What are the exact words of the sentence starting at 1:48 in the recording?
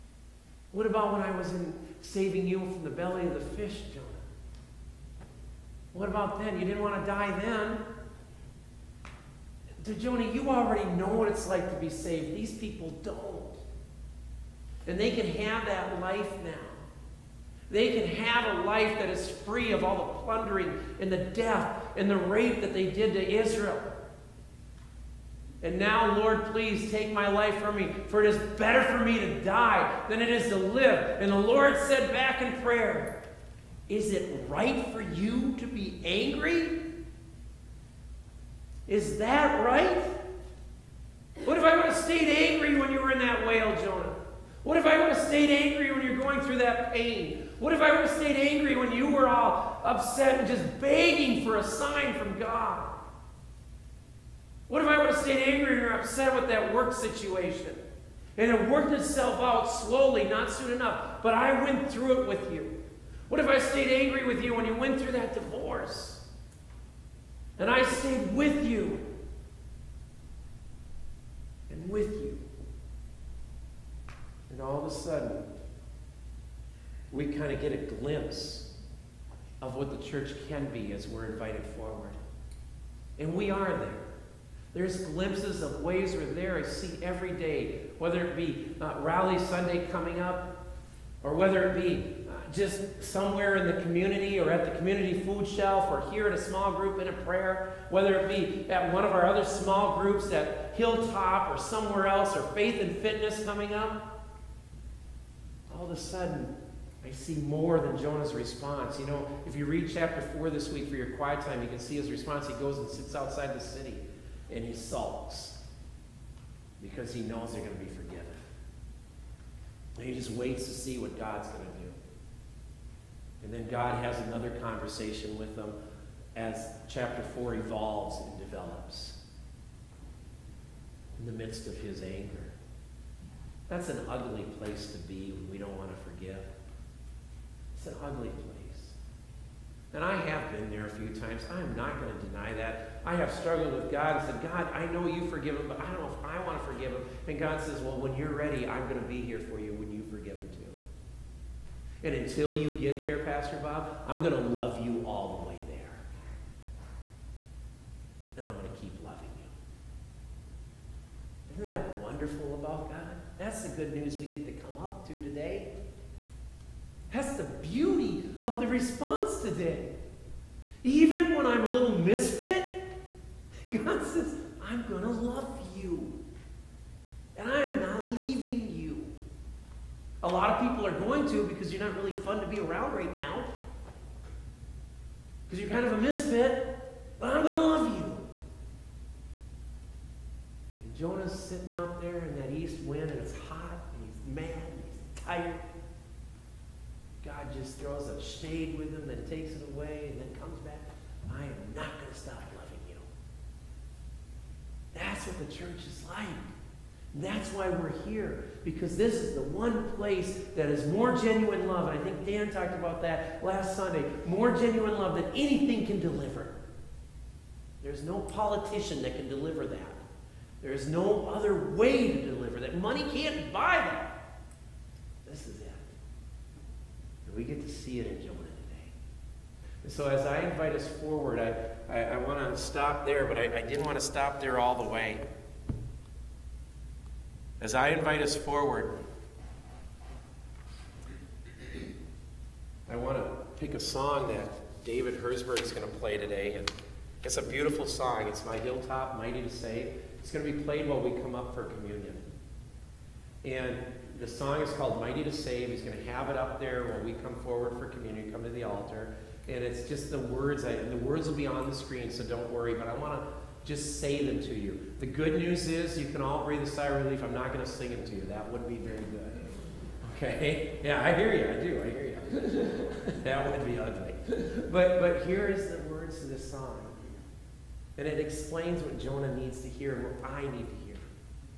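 You know, if you read chapter 4 this week for your quiet time, you can see his response.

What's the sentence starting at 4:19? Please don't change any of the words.
And it's just the words, I, the words will be on the screen, so don't worry.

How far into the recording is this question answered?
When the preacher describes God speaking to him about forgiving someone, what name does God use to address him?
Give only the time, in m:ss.
2:33.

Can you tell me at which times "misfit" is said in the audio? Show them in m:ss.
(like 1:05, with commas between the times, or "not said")
2:51, 3:05.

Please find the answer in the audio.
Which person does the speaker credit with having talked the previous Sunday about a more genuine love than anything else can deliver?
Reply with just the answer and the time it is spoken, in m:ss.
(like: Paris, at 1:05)
Dan, at 3:32.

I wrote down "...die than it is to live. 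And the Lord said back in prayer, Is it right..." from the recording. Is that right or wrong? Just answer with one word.
right.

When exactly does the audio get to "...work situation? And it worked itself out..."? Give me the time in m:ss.
0:56.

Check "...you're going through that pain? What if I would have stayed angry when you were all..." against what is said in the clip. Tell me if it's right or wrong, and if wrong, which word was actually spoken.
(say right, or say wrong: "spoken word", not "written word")
right.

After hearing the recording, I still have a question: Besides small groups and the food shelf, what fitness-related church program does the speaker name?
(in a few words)
Faith and Fitness.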